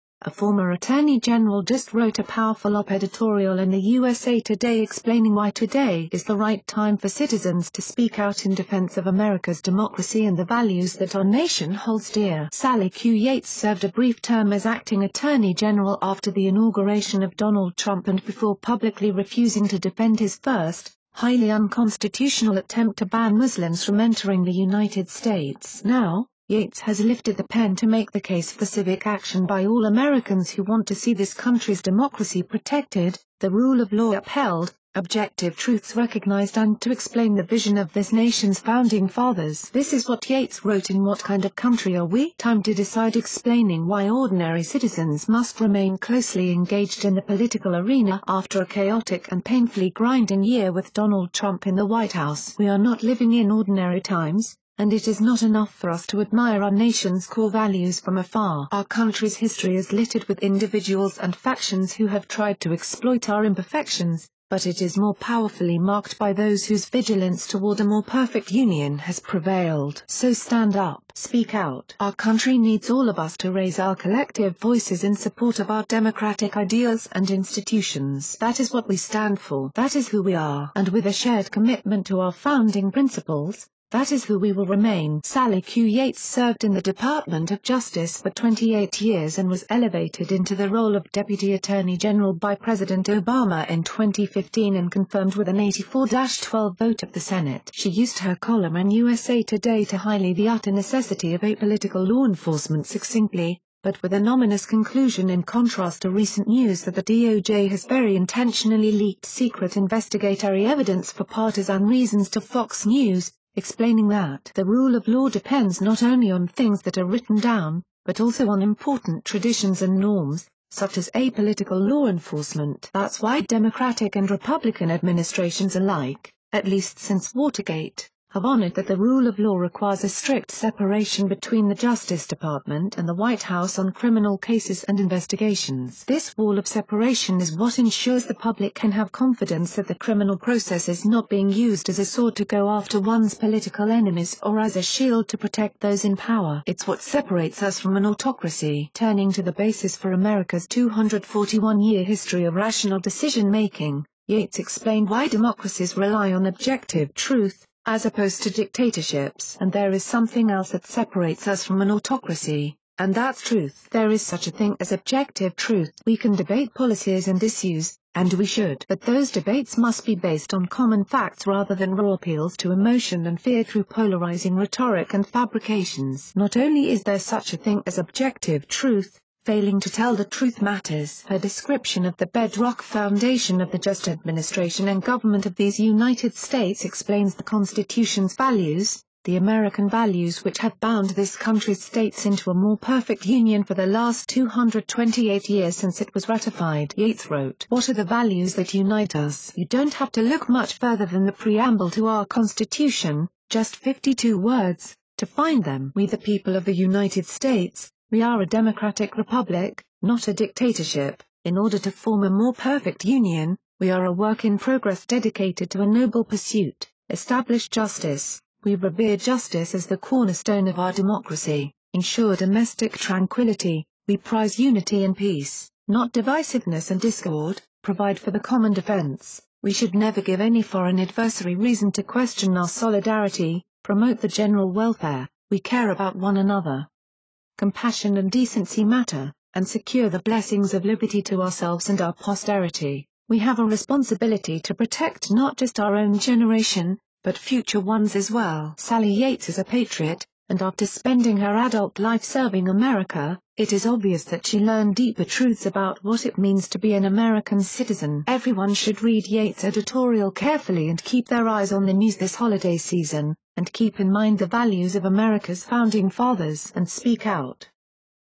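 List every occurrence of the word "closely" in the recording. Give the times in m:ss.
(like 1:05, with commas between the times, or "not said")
0:45.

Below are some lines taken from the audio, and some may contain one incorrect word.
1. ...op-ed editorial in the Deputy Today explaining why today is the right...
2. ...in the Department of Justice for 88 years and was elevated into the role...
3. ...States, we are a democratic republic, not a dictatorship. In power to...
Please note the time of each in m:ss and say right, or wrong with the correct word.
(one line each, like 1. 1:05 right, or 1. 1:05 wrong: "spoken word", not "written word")
1. 0:02 wrong: "USA", not "Deputy"
2. 1:26 wrong: "28", not "88"
3. 3:27 wrong: "order", not "power".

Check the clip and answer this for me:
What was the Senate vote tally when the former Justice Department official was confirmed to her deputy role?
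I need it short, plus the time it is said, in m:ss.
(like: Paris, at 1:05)
84-12, at 1:35.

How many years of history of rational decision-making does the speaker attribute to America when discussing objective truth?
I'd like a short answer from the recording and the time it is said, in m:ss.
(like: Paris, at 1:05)
241, at 2:30.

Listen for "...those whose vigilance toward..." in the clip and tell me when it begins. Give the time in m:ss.
1:06.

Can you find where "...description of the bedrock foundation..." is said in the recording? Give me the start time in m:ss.
3:01.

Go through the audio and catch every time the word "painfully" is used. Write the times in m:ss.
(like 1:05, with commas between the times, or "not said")
0:49.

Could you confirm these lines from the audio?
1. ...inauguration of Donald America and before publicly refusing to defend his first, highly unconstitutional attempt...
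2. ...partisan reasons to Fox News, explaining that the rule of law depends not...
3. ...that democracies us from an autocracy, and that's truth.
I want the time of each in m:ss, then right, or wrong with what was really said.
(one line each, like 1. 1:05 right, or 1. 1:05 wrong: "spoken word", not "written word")
1. 0:16 wrong: "Trump", not "America"
2. 1:51 right
3. 2:40 wrong: "separates", not "democracies".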